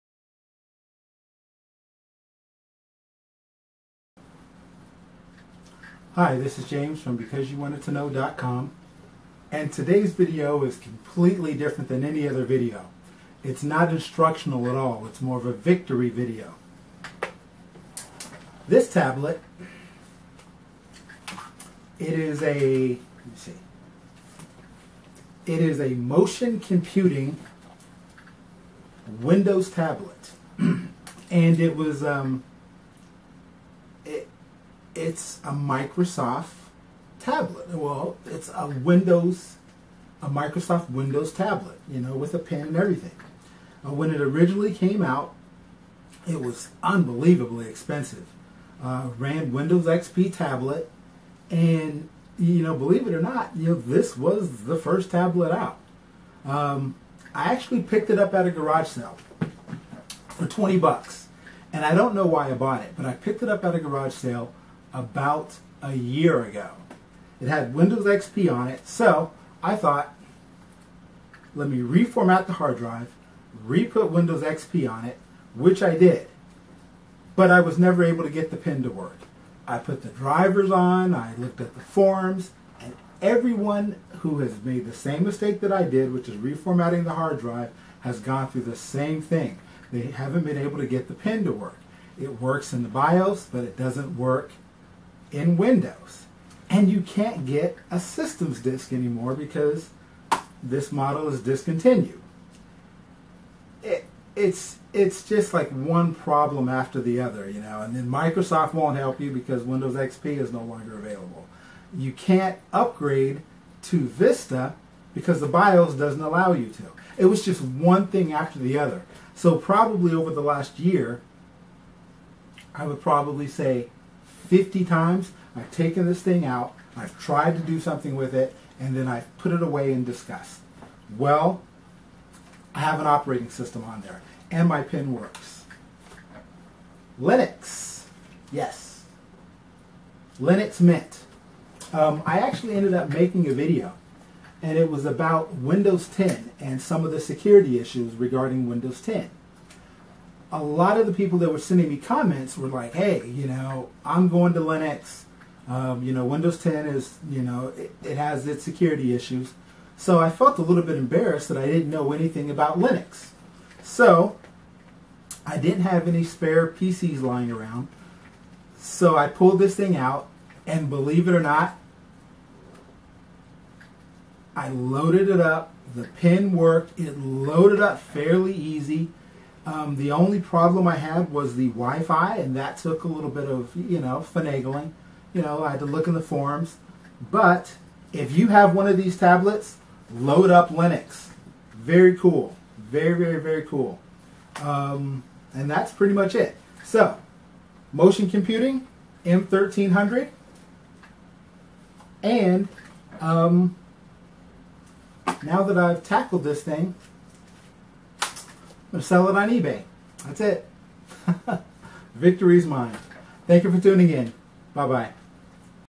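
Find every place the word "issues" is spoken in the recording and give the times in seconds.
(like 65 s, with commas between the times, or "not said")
147 s, 159 s.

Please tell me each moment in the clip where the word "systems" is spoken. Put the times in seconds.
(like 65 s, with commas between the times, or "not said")
97 s, 133 s.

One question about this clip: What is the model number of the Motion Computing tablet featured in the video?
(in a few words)
M1300.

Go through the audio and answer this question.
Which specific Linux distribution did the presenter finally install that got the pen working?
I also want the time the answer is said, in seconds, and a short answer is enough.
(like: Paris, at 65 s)
Linux Mint, at 140 s.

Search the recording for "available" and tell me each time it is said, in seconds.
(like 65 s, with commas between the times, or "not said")
110 s.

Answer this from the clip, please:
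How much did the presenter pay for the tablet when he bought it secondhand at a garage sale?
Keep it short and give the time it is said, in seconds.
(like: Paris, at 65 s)
$20, at 60 s.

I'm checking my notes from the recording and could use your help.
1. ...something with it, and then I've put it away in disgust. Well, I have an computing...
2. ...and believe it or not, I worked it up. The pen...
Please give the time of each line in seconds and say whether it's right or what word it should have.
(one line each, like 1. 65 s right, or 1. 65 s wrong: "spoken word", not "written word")
1. 127 s wrong: "operating", not "computing"
2. 170 s wrong: "loaded", not "worked".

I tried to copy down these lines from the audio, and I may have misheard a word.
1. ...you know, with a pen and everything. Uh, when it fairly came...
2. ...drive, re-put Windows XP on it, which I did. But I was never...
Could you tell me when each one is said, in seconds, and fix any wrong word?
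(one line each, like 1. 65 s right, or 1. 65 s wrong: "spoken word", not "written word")
1. 41 s wrong: "originally", not "fairly"
2. 72 s right.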